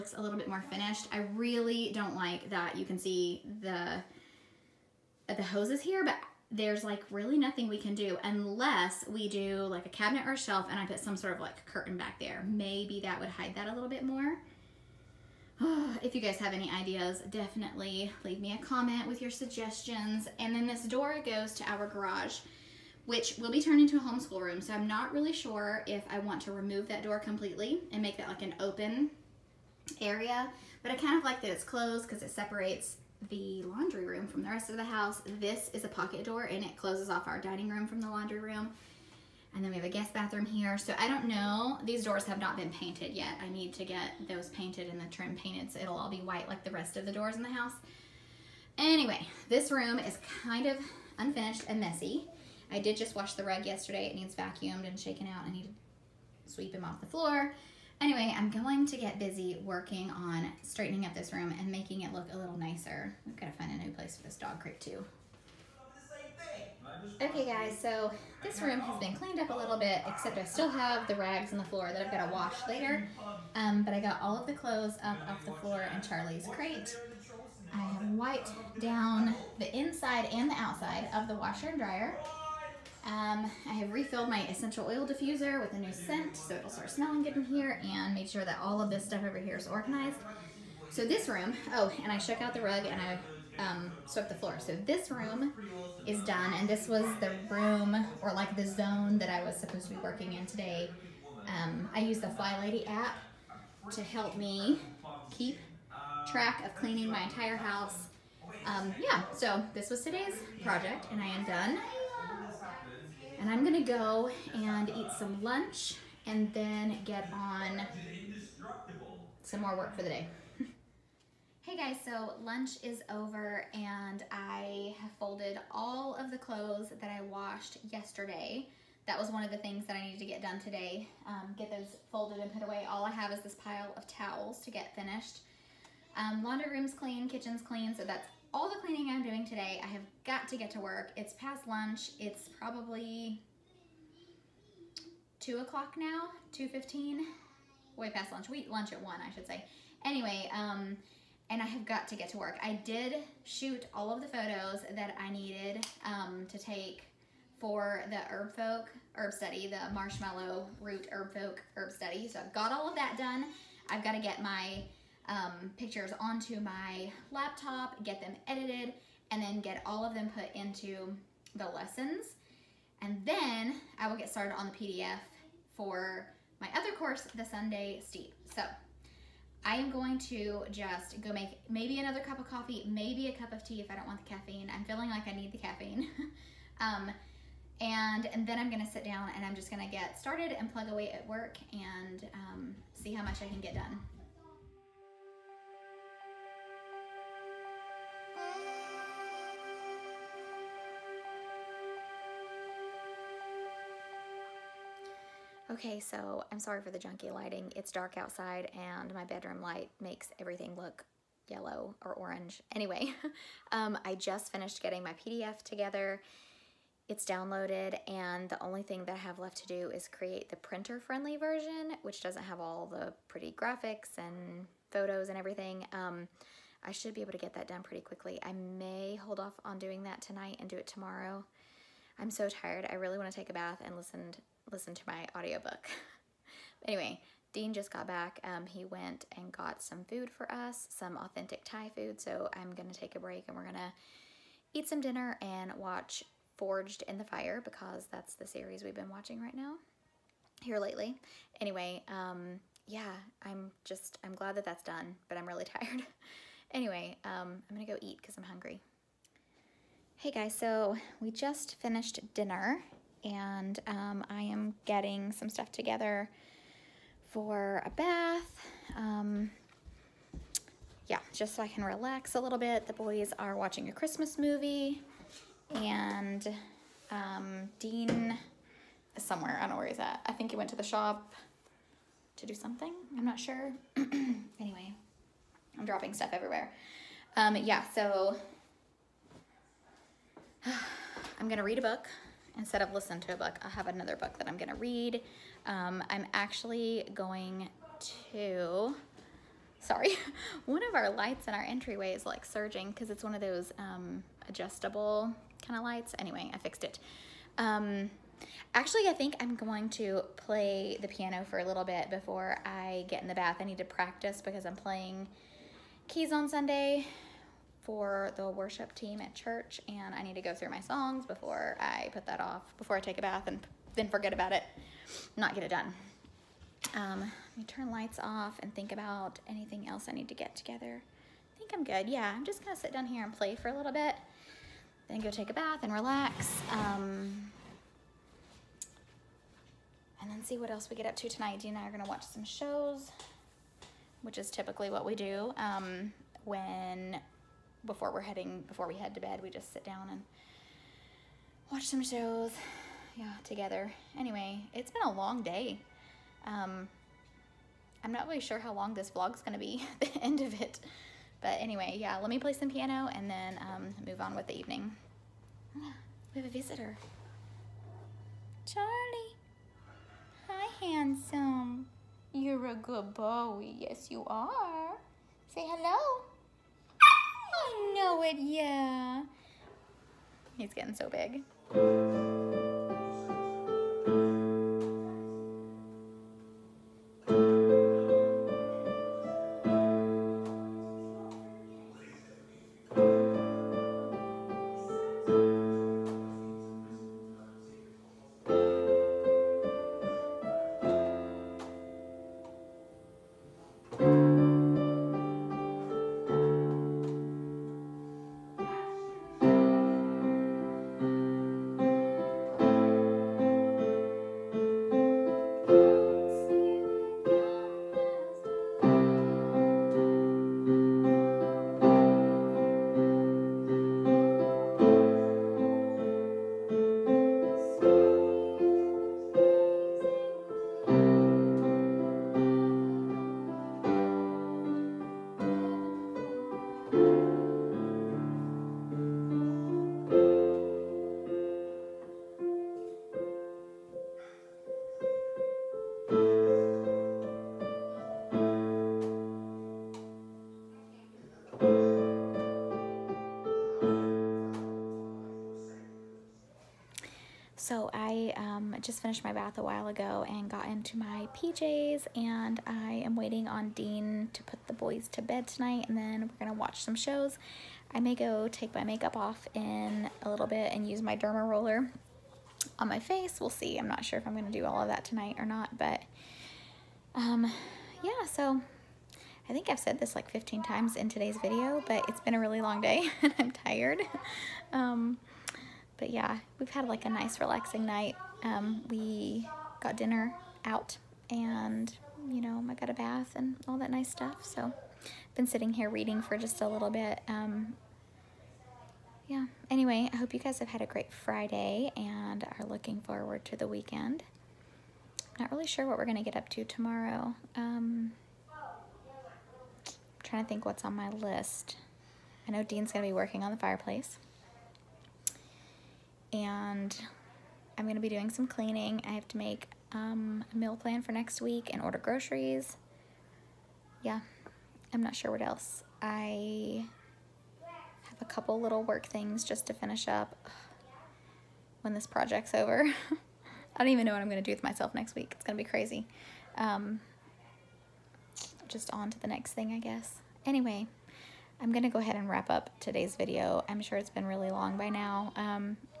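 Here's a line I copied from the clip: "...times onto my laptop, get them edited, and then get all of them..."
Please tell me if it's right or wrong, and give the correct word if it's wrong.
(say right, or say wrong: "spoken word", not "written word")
wrong: "pictures", not "times".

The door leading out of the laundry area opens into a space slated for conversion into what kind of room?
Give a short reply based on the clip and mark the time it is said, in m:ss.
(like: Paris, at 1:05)
homeschool room, at 0:24.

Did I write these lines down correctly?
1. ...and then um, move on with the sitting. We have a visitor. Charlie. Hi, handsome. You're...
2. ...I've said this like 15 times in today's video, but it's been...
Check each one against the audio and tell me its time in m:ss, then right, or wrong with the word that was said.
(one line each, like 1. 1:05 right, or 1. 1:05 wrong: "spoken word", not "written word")
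1. 6:03 wrong: "evening", not "sitting"
2. 7:59 right.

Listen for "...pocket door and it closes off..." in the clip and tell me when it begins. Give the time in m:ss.
0:35.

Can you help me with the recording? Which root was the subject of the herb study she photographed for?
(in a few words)
marshmallow root.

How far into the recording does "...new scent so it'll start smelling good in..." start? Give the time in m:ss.
1:25.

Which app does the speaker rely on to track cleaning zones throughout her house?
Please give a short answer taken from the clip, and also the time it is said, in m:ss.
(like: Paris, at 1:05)
FlyLady, at 1:42.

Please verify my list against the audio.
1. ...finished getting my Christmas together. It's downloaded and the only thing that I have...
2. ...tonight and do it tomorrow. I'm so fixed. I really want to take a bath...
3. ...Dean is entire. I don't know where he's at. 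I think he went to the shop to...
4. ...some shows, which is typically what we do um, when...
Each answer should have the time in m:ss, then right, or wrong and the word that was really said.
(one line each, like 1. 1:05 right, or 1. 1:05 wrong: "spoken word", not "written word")
1. 3:34 wrong: "PDF", not "Christmas"
2. 3:50 wrong: "tired", not "fixed"
3. 4:37 wrong: "somewhere", not "entire"
4. 5:42 right.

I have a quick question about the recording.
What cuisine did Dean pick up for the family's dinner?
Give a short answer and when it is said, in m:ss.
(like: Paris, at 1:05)
Thai, at 4:01.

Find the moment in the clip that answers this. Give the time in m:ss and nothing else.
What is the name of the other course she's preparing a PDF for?
2:57.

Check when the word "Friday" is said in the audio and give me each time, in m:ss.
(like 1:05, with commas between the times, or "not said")
8:21.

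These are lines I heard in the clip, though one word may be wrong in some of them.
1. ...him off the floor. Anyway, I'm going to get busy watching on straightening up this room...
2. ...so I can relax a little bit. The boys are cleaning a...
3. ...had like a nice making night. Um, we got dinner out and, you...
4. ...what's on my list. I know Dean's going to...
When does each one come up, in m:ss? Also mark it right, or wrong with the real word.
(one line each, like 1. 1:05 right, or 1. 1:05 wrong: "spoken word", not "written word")
1. 0:56 wrong: "working", not "watching"
2. 4:31 wrong: "watching", not "cleaning"
3. 8:06 wrong: "relaxing", not "making"
4. 8:30 right.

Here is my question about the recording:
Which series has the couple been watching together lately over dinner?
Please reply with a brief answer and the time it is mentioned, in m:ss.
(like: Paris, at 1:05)
Forged in the Fire, at 4:06.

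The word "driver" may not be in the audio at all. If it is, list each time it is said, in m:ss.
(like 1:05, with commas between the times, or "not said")
not said.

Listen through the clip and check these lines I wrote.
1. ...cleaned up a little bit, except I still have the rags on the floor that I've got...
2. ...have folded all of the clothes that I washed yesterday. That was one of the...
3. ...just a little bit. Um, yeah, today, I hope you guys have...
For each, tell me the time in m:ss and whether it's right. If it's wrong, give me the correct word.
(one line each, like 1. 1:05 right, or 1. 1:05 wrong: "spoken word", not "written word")
1. 1:09 right
2. 2:05 right
3. 8:16 wrong: "anyway", not "today".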